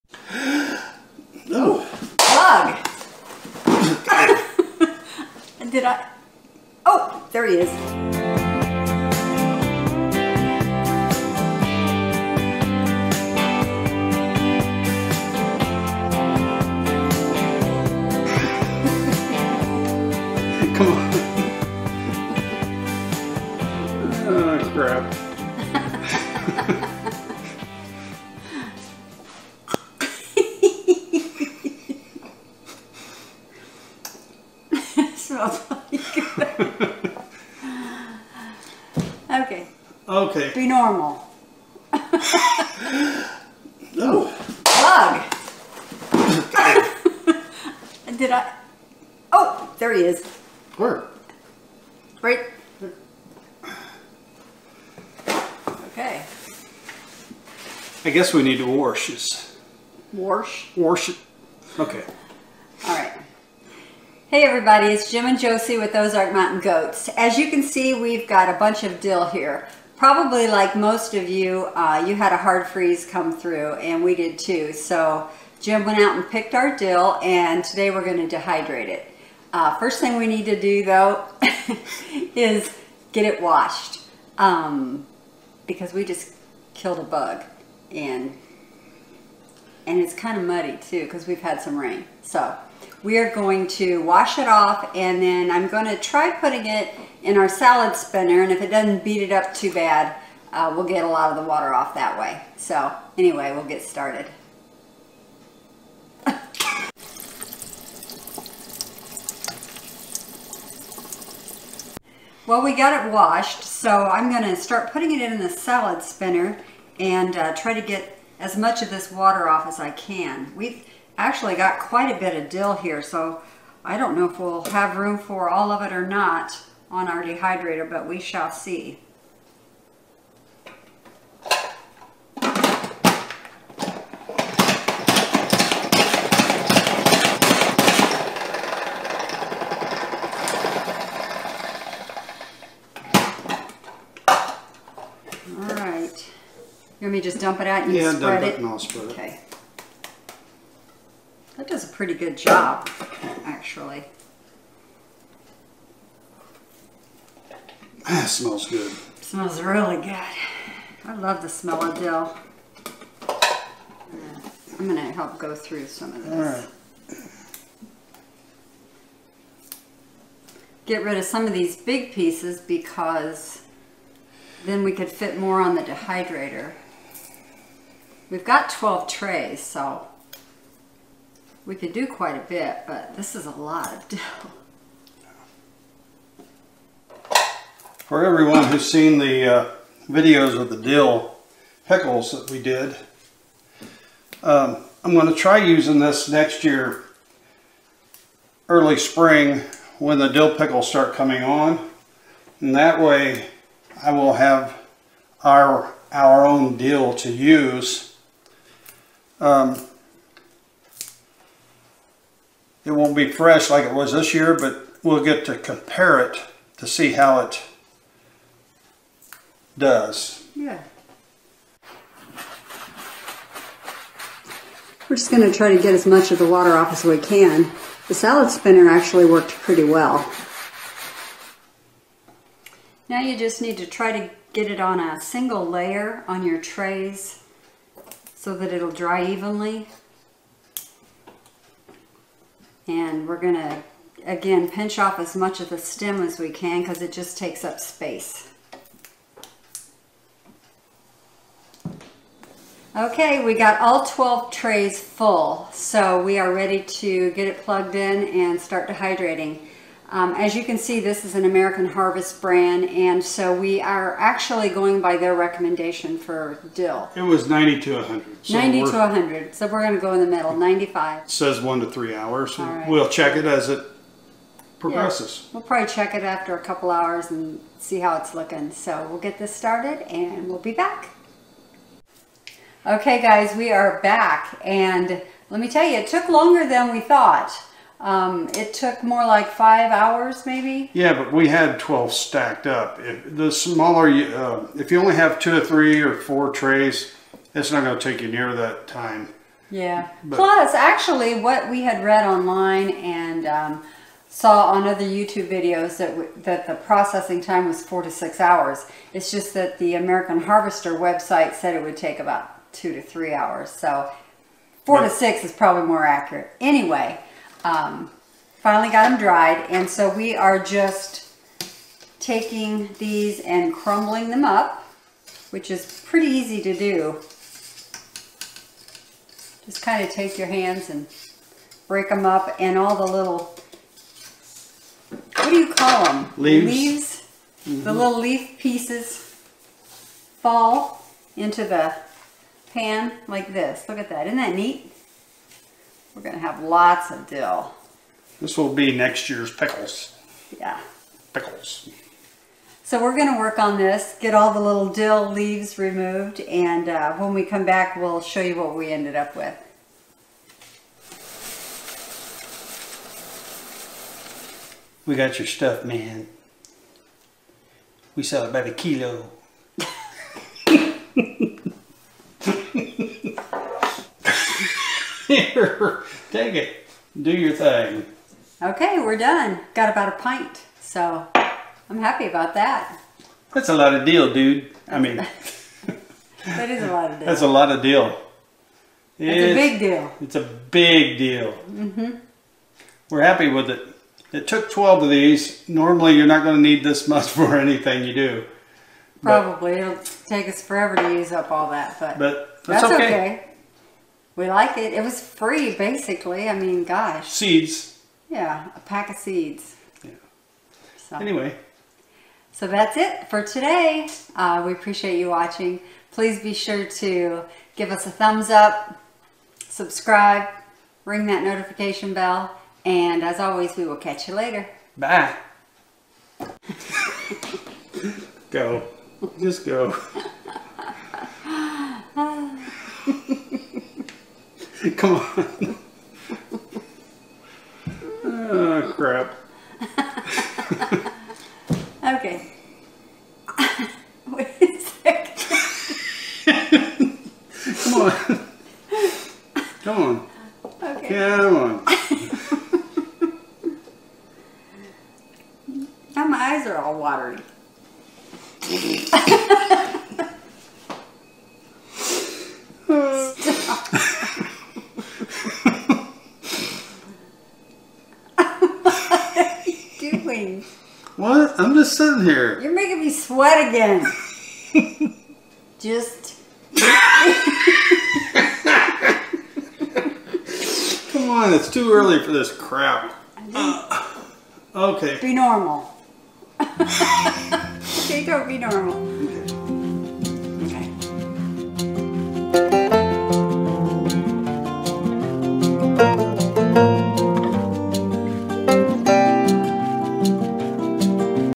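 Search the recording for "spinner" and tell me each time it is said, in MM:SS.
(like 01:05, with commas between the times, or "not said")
01:37, 01:56, 03:48.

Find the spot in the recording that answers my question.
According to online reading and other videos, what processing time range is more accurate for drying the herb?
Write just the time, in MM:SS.
05:07.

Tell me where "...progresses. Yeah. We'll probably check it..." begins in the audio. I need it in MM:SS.
04:34.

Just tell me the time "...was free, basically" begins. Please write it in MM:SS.
06:45.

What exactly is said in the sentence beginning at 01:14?
So Jim went out and picked our dill and today we're gonna dehydrate it.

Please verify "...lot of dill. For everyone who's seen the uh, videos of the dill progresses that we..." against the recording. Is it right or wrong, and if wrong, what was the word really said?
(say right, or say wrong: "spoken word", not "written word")
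wrong: "pickles", not "progresses".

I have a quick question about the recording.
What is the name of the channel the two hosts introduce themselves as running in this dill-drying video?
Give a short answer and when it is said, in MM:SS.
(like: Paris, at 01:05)
Ozark Mountain Goats, at 01:05.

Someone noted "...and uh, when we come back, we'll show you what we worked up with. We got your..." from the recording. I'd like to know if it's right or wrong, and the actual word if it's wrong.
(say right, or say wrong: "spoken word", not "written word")
wrong: "ended", not "worked".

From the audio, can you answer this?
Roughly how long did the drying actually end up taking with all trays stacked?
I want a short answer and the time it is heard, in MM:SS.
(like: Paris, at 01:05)
5 hours, at 04:49.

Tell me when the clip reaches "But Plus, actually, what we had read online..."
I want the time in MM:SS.
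05:00.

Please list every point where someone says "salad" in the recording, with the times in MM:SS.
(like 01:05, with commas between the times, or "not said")
01:37, 01:55, 03:48.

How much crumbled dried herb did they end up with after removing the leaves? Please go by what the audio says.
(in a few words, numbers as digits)
a pint.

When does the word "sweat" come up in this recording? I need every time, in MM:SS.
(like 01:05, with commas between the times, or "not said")
07:53.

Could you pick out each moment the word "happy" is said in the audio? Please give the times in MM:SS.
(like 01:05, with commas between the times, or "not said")
06:21, 06:33.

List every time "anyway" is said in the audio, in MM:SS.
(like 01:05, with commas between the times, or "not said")
01:43, 05:16, 06:51.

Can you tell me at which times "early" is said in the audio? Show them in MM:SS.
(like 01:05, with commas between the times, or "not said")
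03:18, 08:01.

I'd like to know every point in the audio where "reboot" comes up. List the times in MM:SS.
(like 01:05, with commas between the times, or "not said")
not said.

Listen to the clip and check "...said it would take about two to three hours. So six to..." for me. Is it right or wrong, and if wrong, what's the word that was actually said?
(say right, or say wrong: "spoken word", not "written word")
wrong: "four", not "six".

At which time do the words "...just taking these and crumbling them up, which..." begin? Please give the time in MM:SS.
05:20.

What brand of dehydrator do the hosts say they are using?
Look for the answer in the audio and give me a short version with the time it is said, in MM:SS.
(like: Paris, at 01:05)
American Harvest, at 04:21.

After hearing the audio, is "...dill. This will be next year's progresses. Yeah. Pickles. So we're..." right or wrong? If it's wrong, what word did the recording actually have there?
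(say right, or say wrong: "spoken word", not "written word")
wrong: "pickles", not "progresses".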